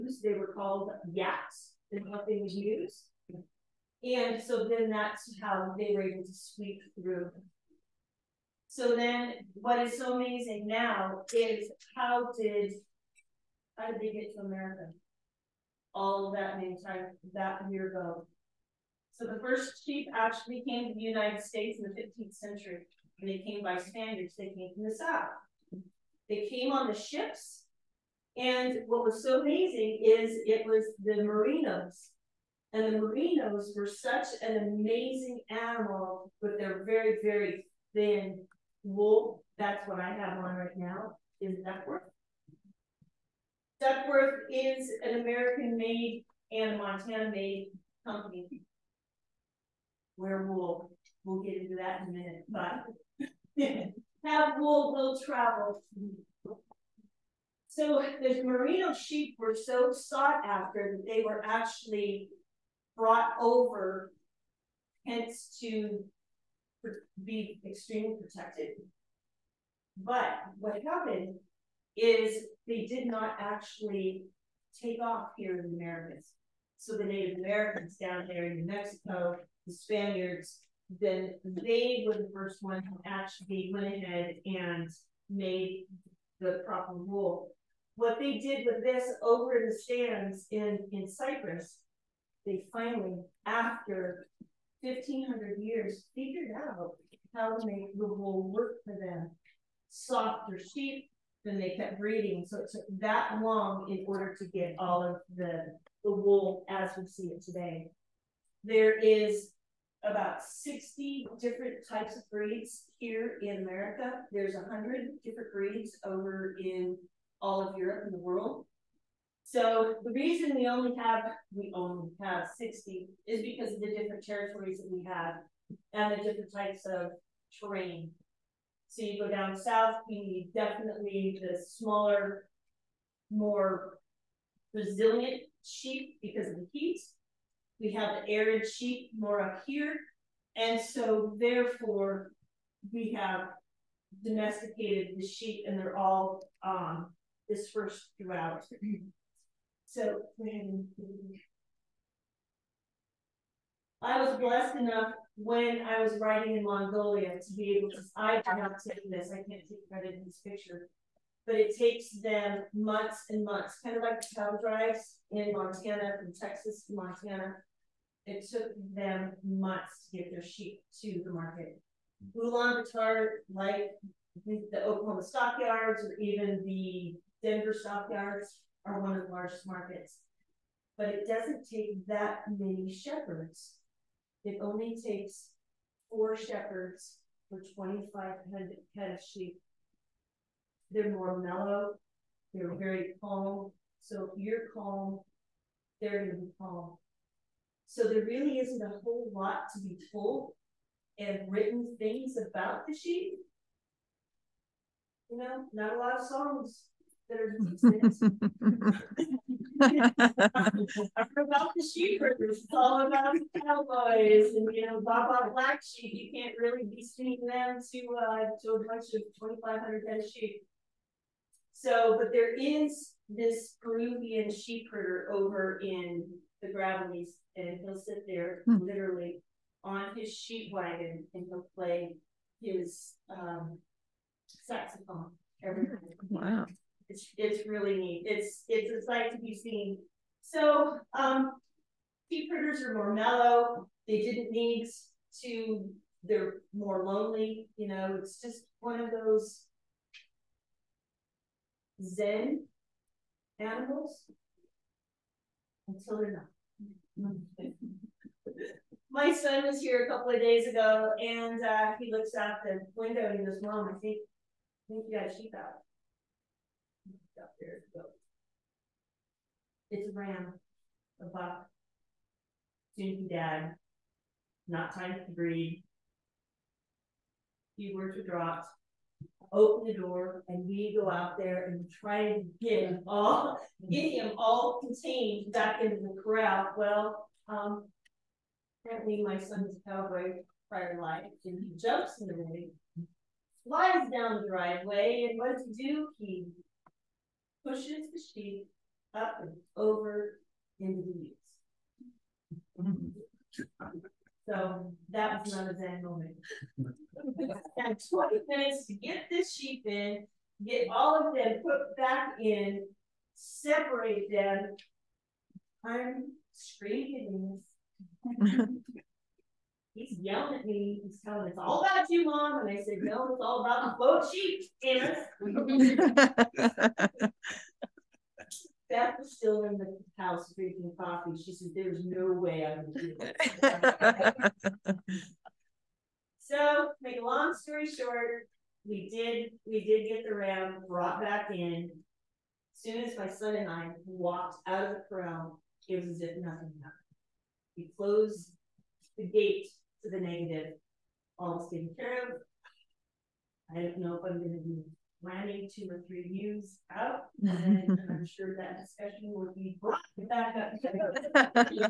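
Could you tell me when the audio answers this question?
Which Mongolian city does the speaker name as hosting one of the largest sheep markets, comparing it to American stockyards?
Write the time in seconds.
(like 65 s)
172 s.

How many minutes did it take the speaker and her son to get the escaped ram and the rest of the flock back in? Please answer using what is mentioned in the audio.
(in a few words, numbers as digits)
20.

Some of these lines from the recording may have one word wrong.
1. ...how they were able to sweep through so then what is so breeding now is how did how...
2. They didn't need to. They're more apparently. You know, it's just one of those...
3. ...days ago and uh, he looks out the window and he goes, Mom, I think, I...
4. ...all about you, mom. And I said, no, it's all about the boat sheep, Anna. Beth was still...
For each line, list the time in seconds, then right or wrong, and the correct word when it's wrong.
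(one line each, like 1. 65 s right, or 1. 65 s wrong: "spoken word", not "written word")
1. 5 s wrong: "amazing", not "breeding"
2. 244 s wrong: "lonely", not "apparently"
3. 260 s right
4. 321 s right.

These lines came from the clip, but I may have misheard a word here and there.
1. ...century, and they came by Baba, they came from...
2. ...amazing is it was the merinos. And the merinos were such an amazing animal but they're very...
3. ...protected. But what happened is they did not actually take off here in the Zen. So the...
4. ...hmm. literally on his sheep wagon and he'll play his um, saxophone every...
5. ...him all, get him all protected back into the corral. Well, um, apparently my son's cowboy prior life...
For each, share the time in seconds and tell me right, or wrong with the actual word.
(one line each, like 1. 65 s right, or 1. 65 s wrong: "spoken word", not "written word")
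1. 22 s wrong: "Spaniards", not "Baba"
2. 29 s right
3. 68 s wrong: "Americas", not "Zen"
4. 228 s right
5. 282 s wrong: "contained", not "protected".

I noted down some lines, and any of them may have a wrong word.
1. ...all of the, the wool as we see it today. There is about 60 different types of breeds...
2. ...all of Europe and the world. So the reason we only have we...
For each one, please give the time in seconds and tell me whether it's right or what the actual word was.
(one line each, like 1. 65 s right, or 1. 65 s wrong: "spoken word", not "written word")
1. 104 s right
2. 117 s right.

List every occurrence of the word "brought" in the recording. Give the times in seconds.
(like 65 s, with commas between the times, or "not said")
62 s, 340 s, 359 s.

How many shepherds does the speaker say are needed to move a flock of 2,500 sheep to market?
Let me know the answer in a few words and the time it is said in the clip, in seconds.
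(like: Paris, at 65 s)
4, at 186 s.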